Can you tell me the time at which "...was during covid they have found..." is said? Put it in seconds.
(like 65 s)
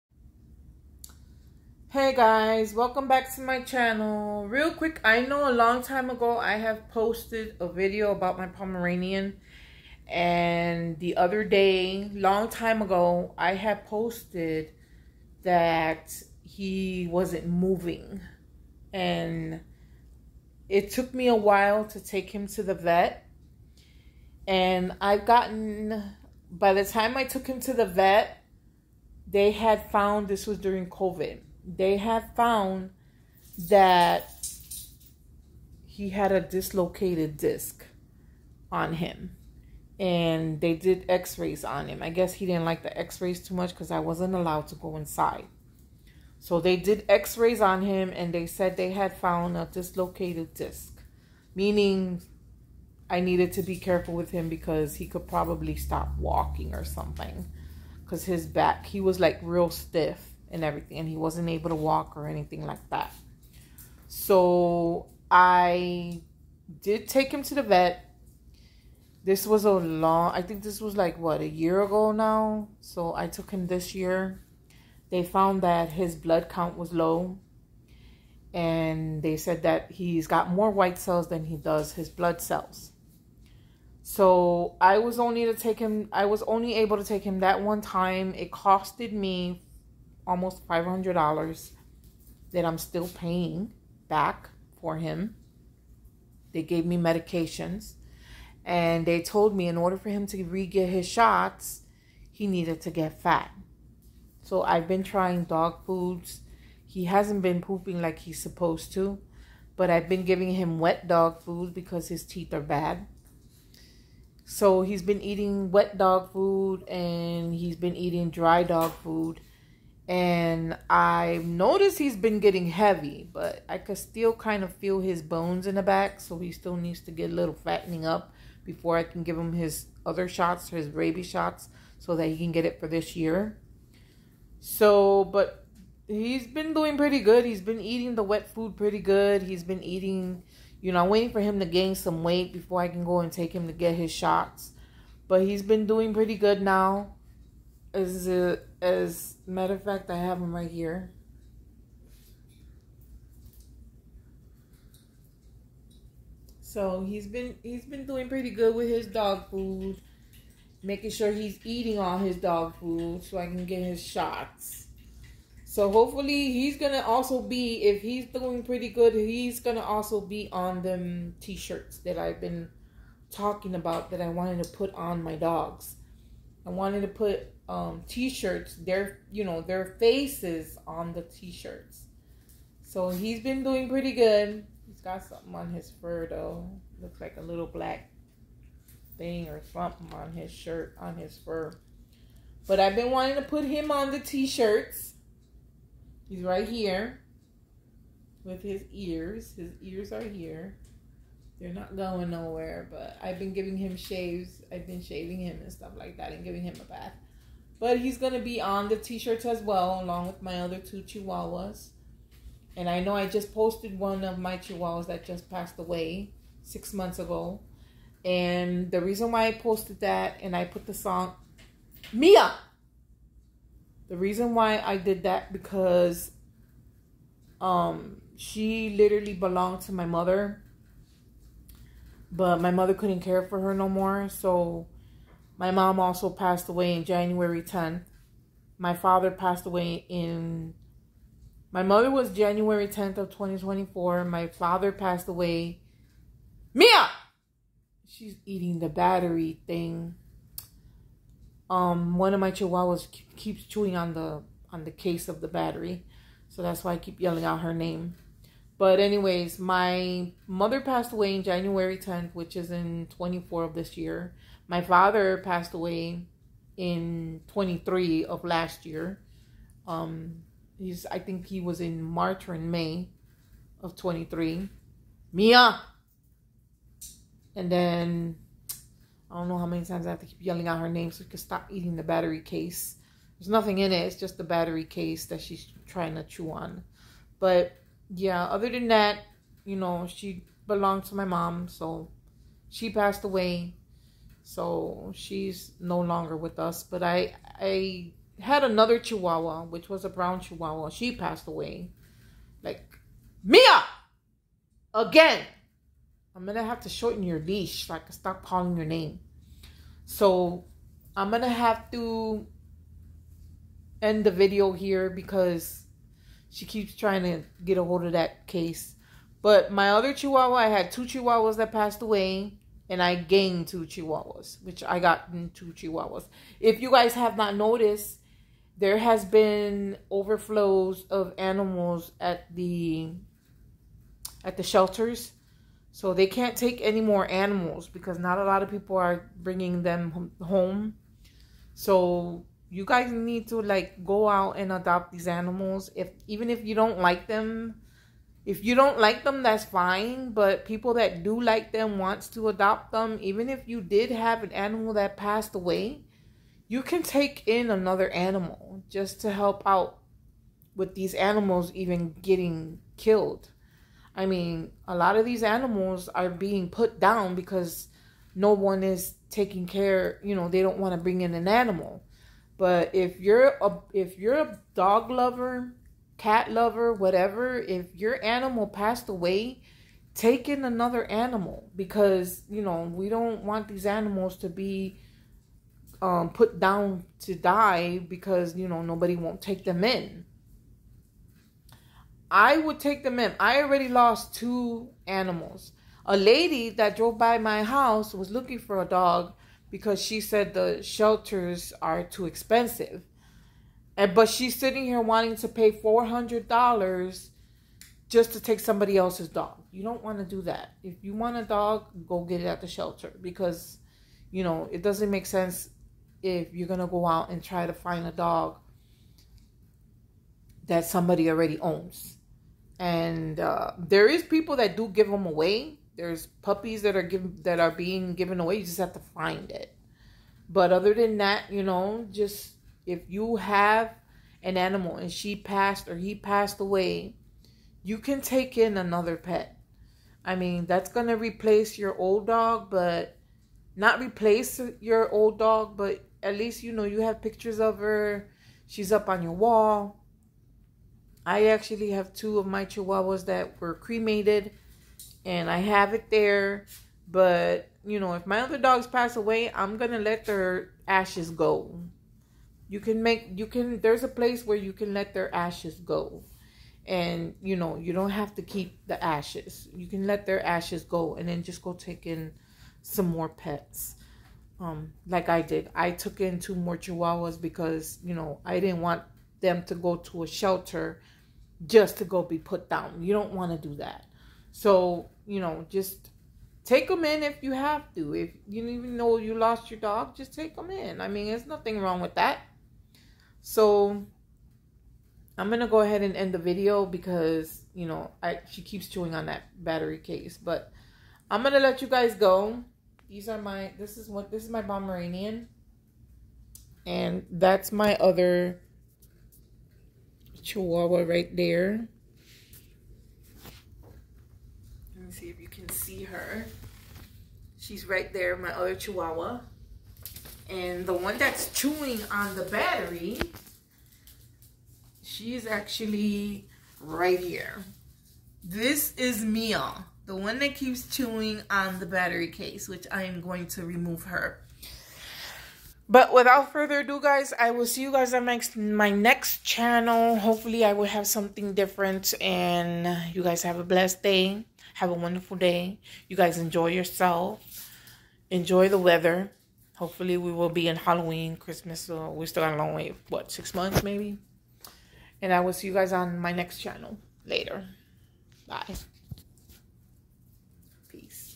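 30 s.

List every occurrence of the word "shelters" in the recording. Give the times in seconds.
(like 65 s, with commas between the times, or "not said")
334 s, 400 s, 412 s, 480 s.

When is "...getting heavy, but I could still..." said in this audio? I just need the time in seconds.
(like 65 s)
122 s.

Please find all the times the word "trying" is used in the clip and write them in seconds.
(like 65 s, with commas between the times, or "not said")
105 s, 285 s, 316 s.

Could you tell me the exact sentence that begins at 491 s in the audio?
I mean, there's nothing wrong with that.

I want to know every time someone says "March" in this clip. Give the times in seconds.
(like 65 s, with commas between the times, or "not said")
272 s.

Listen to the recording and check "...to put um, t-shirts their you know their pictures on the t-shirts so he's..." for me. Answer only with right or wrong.
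wrong.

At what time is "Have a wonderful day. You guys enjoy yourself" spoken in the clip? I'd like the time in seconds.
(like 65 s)
544 s.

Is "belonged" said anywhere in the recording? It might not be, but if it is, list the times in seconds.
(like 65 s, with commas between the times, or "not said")
229 s, 290 s.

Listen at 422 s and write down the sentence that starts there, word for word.
And uh, there is people that do give them away, there's puppies that are given that are being given away.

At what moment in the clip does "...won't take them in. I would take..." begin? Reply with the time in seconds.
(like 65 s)
389 s.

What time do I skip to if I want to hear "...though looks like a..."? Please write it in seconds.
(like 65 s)
186 s.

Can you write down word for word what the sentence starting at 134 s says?
So, but he's been doing pretty good.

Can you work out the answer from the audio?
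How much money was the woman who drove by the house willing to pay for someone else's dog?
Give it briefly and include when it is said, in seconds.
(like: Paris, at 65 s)
$400, at 405 s.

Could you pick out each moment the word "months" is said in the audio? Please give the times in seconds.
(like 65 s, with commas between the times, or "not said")
216 s, 553 s.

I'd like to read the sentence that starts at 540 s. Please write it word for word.
Hopefully, I will have something different.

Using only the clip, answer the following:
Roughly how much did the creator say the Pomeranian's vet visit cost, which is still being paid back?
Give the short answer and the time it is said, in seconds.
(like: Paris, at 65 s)
$500, at 90 s.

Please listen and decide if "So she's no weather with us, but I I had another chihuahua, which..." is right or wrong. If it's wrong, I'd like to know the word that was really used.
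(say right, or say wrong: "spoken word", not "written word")
wrong: "longer", not "weather".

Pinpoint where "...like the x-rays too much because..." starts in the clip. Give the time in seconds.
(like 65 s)
42 s.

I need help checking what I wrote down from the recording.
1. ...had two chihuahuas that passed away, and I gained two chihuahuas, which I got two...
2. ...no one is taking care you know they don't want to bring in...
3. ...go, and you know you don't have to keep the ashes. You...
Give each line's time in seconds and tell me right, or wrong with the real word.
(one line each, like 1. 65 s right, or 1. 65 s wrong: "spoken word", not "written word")
1. 320 s right
2. 368 s right
3. 465 s right.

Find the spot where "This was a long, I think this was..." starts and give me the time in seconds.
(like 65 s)
69 s.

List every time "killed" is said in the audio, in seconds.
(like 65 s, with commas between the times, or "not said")
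362 s.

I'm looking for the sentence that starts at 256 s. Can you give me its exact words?
So that's why I keep yelling out her name.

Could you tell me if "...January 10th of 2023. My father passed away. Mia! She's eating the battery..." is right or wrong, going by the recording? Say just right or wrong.
wrong.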